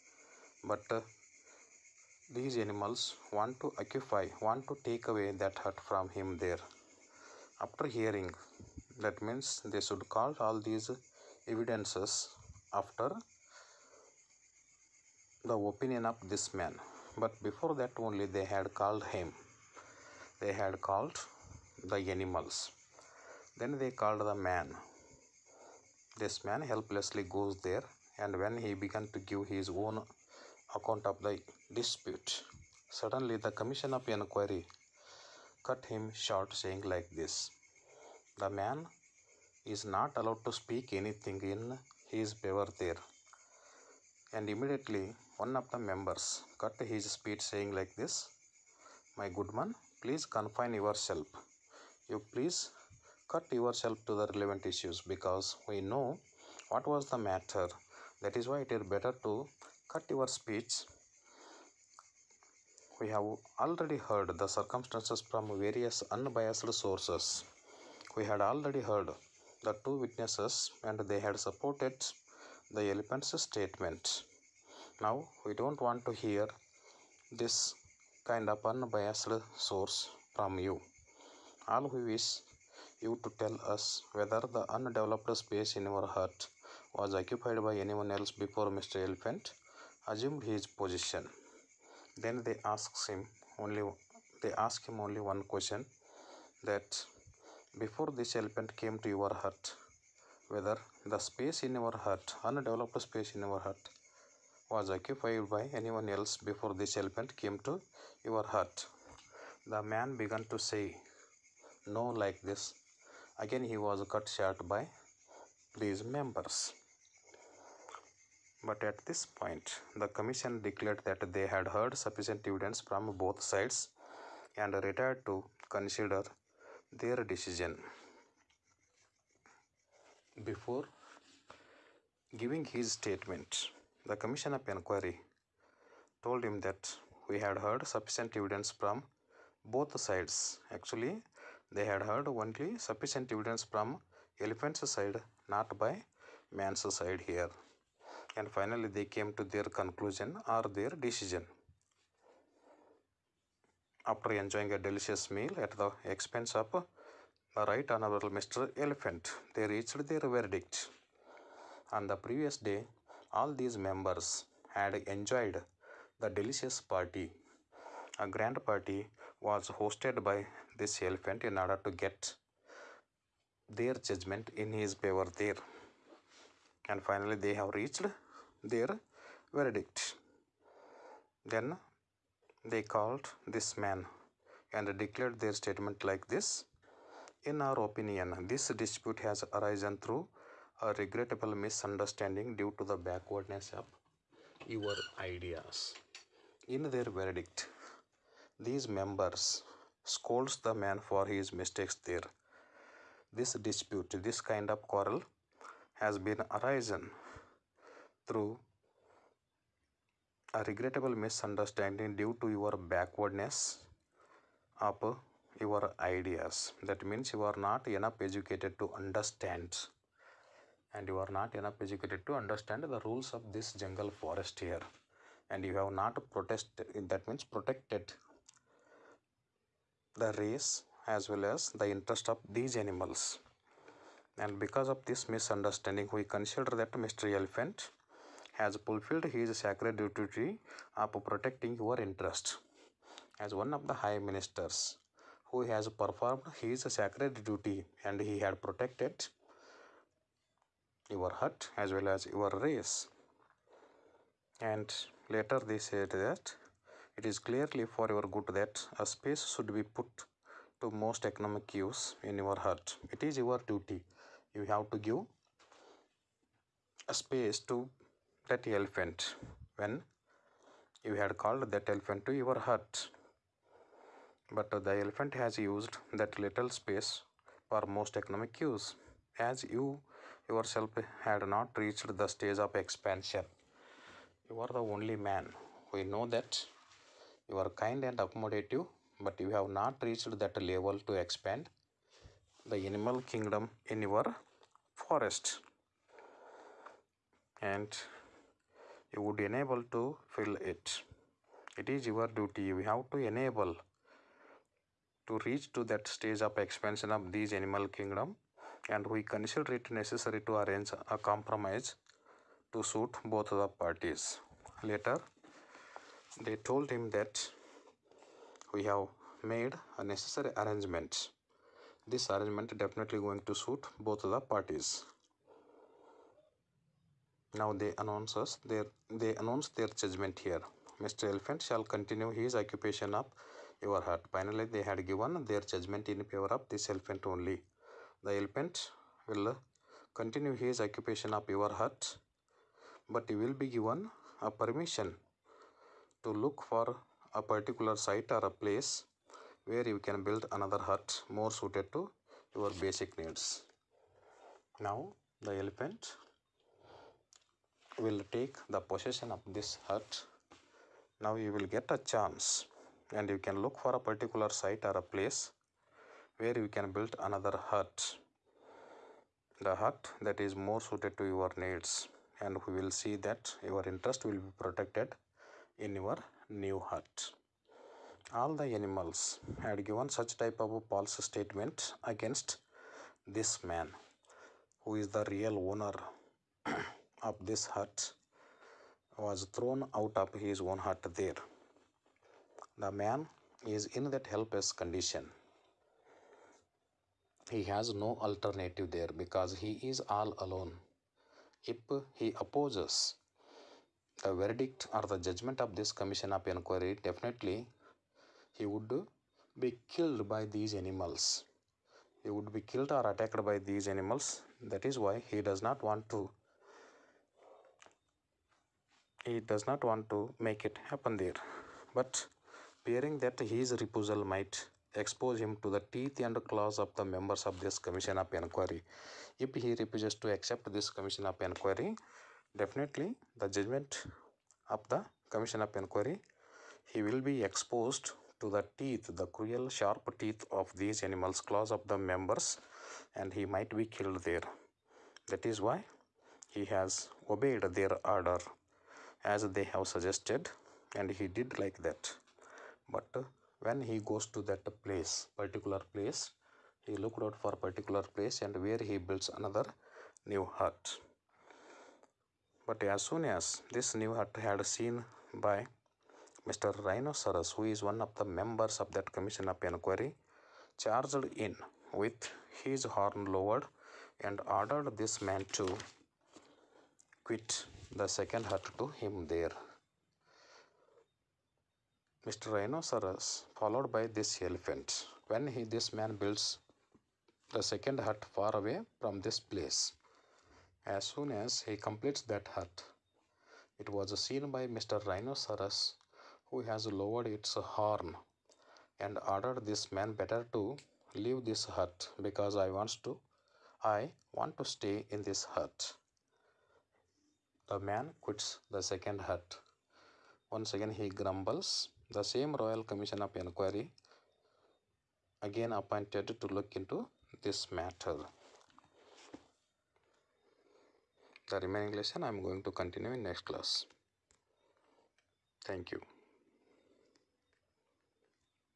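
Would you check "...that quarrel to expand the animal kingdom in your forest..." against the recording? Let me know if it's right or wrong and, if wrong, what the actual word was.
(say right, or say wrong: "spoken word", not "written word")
wrong: "level", not "quarrel".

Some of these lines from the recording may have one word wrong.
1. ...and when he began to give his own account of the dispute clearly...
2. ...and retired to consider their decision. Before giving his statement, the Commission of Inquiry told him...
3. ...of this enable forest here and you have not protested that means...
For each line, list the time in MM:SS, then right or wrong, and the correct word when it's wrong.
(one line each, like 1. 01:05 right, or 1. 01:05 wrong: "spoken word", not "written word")
1. 00:28 wrong: "suddenly", not "clearly"
2. 02:04 right
3. 03:43 wrong: "jungle", not "enable".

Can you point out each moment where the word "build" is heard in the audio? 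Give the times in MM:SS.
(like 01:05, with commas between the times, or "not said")
05:50, 06:06, 07:38, 08:06.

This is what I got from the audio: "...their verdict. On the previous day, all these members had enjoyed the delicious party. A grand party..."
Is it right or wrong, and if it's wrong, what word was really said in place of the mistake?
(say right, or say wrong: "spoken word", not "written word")
right.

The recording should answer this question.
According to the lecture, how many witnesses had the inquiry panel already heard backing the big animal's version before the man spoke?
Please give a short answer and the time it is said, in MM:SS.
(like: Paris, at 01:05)
2, at 01:09.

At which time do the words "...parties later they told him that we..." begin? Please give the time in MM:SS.
05:13.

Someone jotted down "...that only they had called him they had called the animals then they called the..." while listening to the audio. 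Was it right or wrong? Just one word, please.
right.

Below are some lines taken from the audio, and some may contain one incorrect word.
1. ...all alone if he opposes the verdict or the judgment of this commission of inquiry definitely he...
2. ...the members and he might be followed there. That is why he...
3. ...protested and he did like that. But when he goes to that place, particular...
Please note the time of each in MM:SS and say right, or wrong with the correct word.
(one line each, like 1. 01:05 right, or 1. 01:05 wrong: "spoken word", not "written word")
1. 06:40 right
2. 07:21 wrong: "killed", not "followed"
3. 07:29 wrong: "suggested", not "protested".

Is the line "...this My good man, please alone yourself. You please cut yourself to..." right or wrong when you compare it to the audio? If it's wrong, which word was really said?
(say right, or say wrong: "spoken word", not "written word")
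wrong: "confine", not "alone".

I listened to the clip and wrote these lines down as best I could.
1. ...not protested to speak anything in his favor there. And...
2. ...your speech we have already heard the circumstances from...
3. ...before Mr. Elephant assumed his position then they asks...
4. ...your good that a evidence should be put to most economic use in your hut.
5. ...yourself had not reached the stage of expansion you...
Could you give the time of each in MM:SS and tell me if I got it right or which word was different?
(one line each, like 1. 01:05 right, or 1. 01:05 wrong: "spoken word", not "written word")
1. 00:39 wrong: "allowed", not "protested"
2. 01:00 right
3. 01:28 right
4. 04:18 wrong: "space", not "evidence"
5. 04:40 right.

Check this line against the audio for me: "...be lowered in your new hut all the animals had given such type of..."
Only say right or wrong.
wrong.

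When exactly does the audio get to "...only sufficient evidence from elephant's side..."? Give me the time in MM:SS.
02:22.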